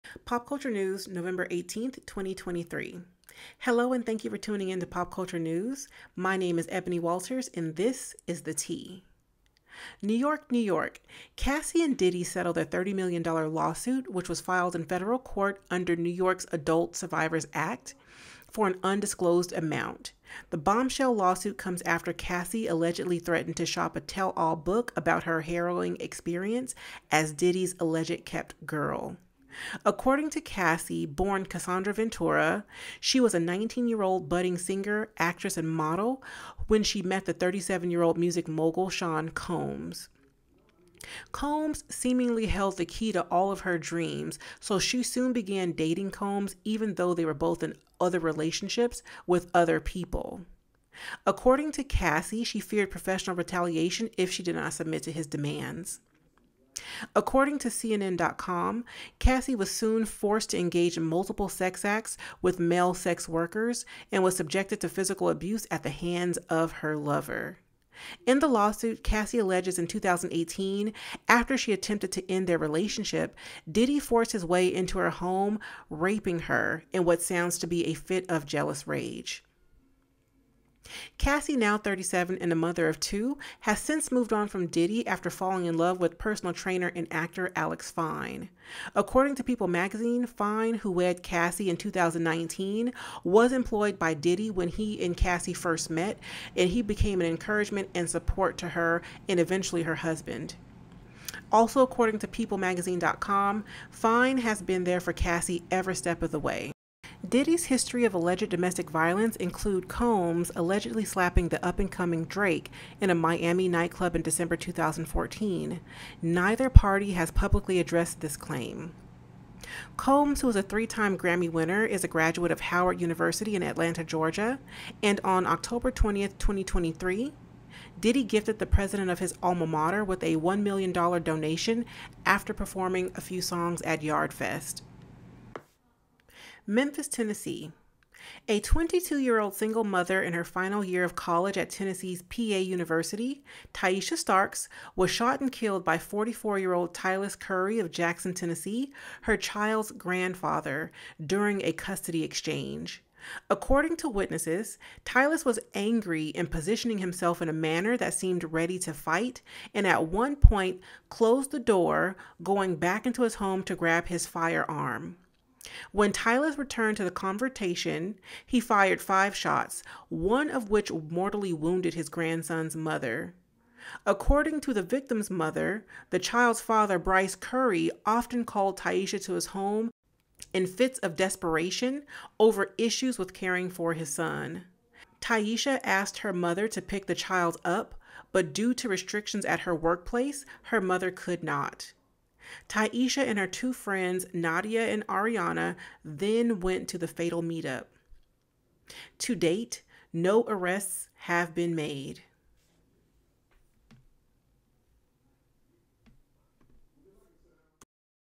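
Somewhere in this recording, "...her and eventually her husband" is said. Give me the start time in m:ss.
1:38.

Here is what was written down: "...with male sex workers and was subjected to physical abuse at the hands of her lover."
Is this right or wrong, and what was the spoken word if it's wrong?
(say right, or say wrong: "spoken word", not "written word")
right.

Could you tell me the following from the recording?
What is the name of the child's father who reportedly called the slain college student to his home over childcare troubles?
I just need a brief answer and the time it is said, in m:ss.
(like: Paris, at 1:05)
Bryce Currie, at 2:56.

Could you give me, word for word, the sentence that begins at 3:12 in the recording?
Tyeasha and her two friends, Nadia and Ariana, then went to the fatal meetup.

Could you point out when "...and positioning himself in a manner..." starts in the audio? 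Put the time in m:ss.
2:36.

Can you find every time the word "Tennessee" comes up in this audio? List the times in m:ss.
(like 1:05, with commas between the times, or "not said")
2:17, 2:21, 2:28.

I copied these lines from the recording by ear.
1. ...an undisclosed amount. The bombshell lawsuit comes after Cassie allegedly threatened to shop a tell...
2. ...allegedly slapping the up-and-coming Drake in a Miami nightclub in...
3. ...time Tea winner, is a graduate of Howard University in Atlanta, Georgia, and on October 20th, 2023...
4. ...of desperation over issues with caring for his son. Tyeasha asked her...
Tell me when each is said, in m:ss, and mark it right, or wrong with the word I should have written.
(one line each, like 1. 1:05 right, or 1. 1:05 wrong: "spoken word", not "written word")
1. 0:18 right
2. 1:50 right
3. 2:00 wrong: "Grammy", not "Tea"
4. 3:00 right.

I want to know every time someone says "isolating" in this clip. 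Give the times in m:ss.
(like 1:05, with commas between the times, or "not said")
not said.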